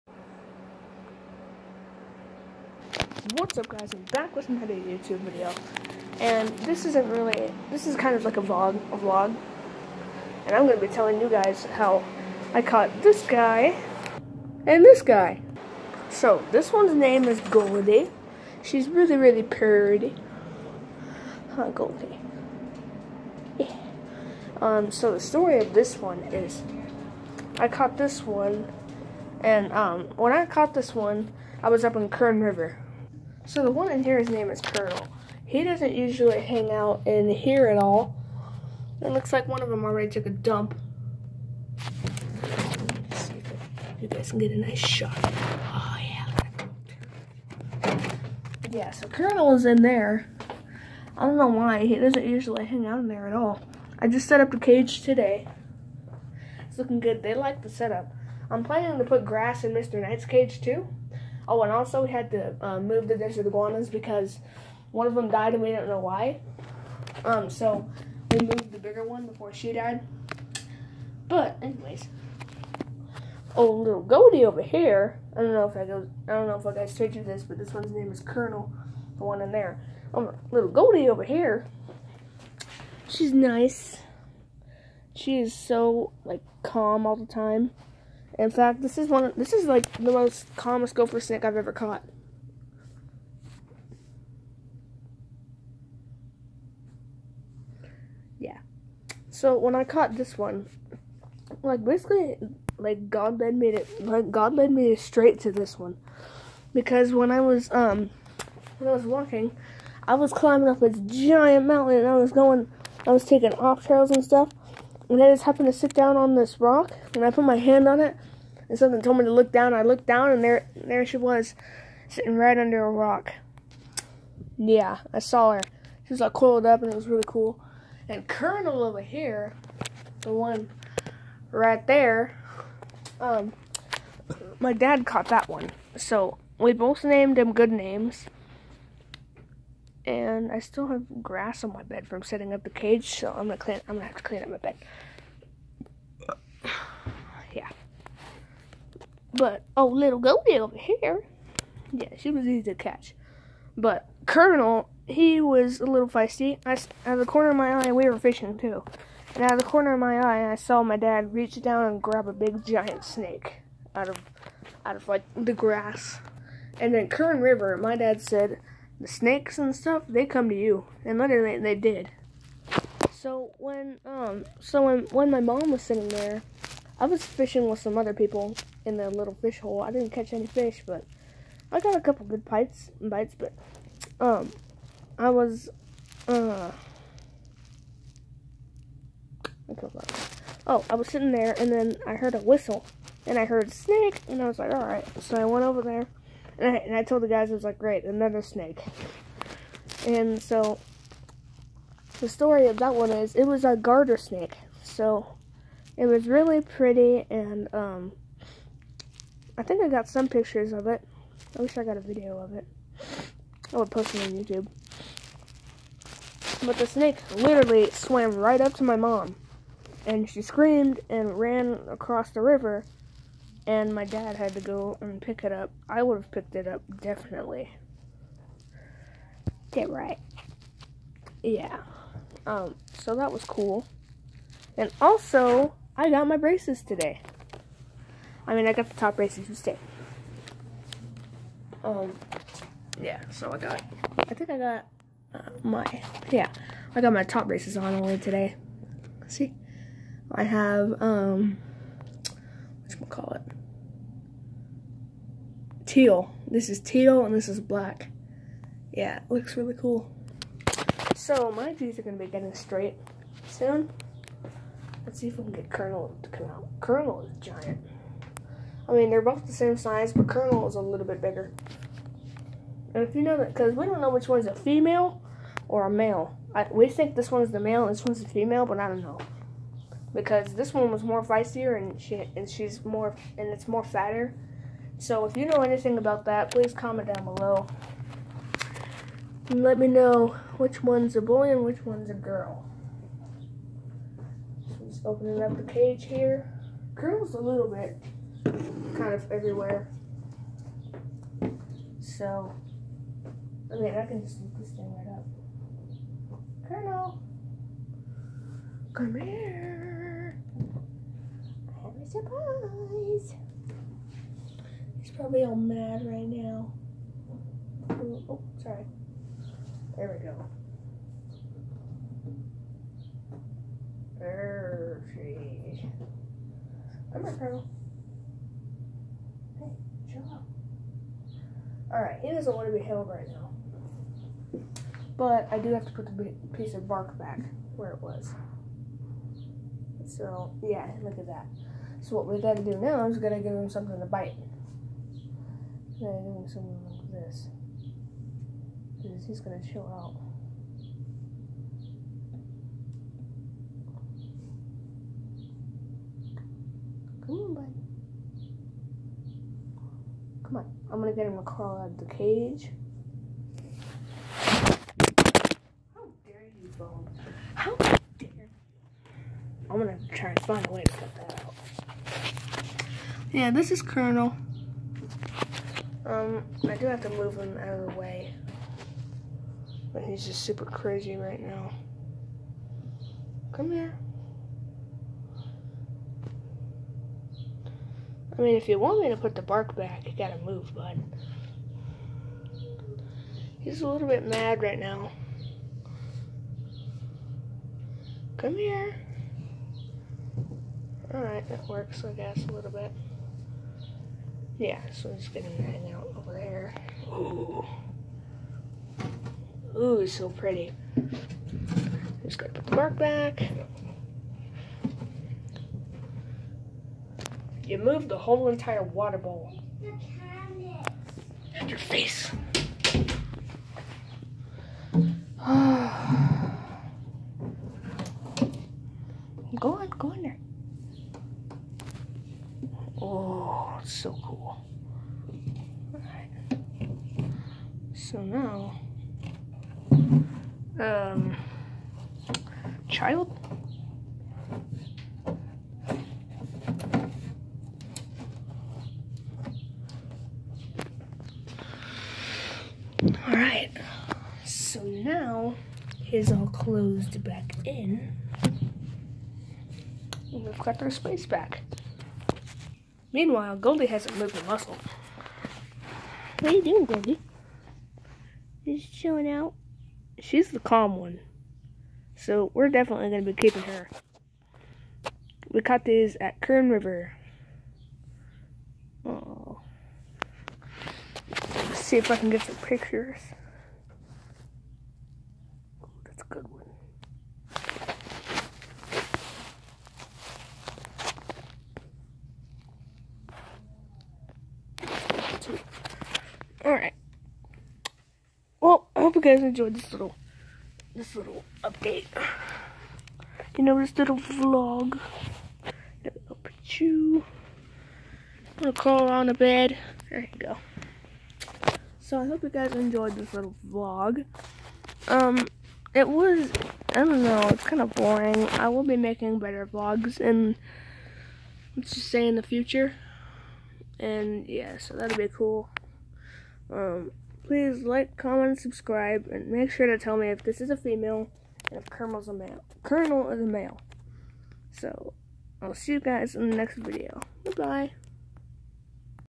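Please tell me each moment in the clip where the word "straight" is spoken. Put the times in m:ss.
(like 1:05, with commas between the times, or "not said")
1:44, 4:22.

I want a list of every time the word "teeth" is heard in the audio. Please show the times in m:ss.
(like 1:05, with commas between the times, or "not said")
4:21.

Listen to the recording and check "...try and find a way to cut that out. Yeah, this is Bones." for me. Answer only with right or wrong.
wrong.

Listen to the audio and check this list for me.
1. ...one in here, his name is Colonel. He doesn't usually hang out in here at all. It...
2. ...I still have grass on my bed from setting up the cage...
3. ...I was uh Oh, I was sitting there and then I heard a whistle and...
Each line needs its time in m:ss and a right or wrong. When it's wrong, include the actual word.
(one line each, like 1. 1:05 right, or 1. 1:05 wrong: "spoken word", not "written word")
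1. 0:33 right
2. 2:20 right
3. 3:05 right.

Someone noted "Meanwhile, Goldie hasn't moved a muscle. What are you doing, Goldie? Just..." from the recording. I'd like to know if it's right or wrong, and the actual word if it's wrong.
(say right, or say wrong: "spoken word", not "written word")
right.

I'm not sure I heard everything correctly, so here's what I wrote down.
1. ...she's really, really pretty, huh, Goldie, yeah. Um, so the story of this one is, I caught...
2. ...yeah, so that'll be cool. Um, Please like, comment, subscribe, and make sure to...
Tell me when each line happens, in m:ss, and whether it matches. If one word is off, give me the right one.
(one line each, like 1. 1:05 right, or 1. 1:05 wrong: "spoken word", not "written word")
1. 0:18 right
2. 8:44 right.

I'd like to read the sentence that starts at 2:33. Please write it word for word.
But Colonel, he was a little feisty.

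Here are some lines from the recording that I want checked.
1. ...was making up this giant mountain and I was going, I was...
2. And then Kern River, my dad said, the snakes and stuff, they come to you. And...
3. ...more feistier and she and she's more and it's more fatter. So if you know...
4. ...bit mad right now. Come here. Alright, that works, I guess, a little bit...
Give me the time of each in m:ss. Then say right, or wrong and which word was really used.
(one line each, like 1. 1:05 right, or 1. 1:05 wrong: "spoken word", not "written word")
1. 1:50 wrong: "climbing", not "making"
2. 2:46 right
3. 4:41 right
4. 6:34 right.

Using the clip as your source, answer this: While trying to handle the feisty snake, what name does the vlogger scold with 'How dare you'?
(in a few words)
Bones.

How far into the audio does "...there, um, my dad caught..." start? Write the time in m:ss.
2:11.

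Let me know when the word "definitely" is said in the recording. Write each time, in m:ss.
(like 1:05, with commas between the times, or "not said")
3:46, 7:52.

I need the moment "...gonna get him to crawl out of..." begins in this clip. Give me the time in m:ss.
6:00.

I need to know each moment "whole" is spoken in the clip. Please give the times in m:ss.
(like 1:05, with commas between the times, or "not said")
6:58.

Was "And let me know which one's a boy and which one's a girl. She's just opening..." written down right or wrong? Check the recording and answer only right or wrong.
right.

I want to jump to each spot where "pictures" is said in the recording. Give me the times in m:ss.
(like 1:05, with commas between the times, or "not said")
3:30, 8:02.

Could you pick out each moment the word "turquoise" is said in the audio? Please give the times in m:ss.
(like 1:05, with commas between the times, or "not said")
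not said.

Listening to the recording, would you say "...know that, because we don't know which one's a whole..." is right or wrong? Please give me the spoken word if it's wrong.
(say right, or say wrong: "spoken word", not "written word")
wrong: "female", not "whole".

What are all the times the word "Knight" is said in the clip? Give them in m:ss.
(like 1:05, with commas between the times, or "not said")
1:00.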